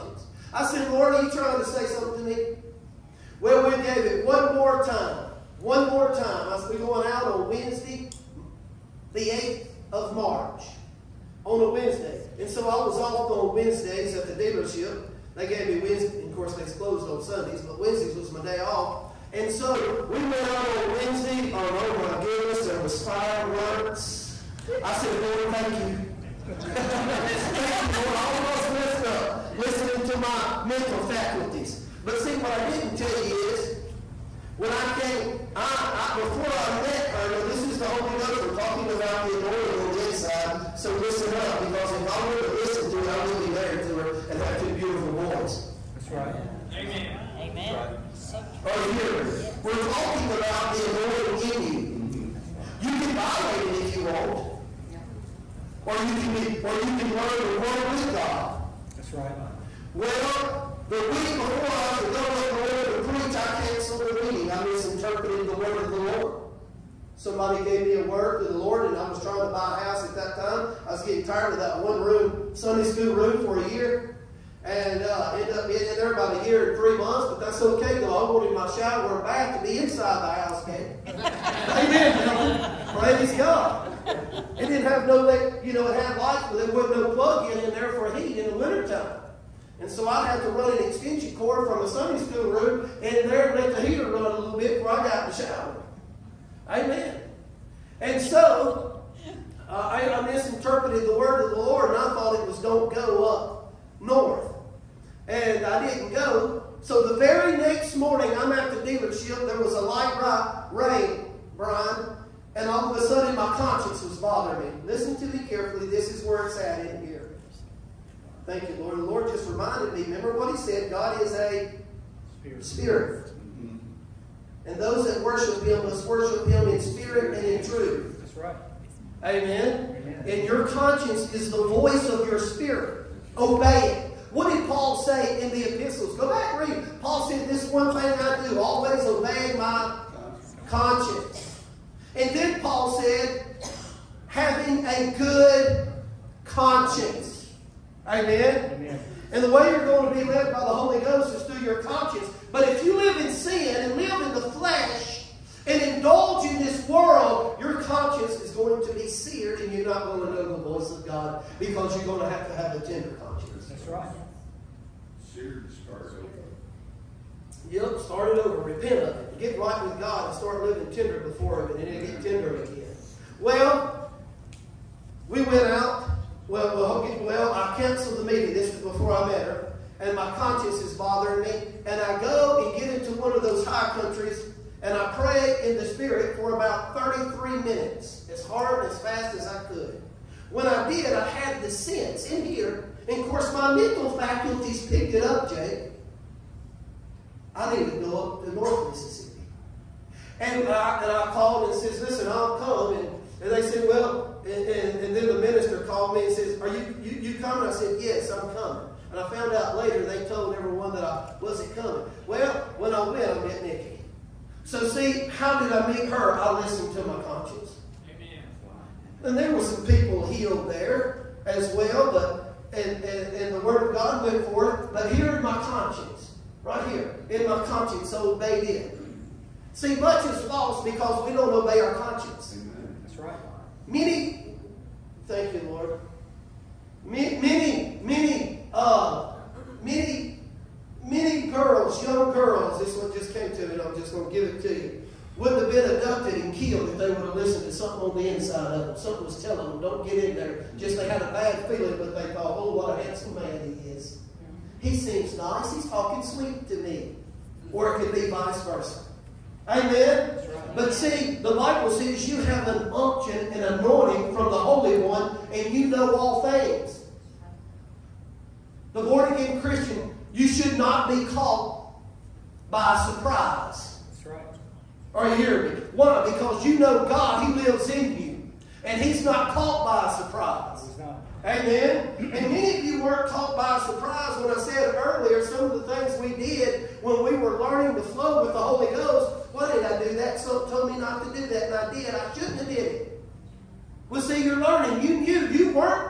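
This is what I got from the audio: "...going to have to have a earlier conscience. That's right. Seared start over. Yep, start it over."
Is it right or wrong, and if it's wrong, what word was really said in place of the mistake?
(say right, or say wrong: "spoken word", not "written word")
wrong: "tender", not "earlier".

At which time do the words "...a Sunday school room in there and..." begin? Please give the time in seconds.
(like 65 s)
91 s.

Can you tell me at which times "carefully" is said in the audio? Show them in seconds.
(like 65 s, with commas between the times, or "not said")
115 s.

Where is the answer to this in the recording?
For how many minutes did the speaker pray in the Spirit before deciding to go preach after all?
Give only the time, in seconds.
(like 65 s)
186 s.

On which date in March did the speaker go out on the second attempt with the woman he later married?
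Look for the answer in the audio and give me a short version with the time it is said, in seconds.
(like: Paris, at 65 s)
March 8, at 9 s.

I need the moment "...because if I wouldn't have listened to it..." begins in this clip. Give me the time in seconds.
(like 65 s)
41 s.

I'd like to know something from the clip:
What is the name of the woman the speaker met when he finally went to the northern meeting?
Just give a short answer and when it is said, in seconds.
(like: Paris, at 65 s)
Nikki, at 213 s.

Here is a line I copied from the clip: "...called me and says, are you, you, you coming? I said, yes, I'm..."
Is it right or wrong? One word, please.
right.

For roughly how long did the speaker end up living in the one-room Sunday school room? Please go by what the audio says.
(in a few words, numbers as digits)
a year and three months.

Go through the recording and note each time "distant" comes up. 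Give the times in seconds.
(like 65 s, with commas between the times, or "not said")
not said.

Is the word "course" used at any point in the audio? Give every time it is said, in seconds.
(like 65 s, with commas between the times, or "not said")
16 s, 193 s.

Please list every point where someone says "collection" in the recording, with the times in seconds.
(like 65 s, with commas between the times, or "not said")
not said.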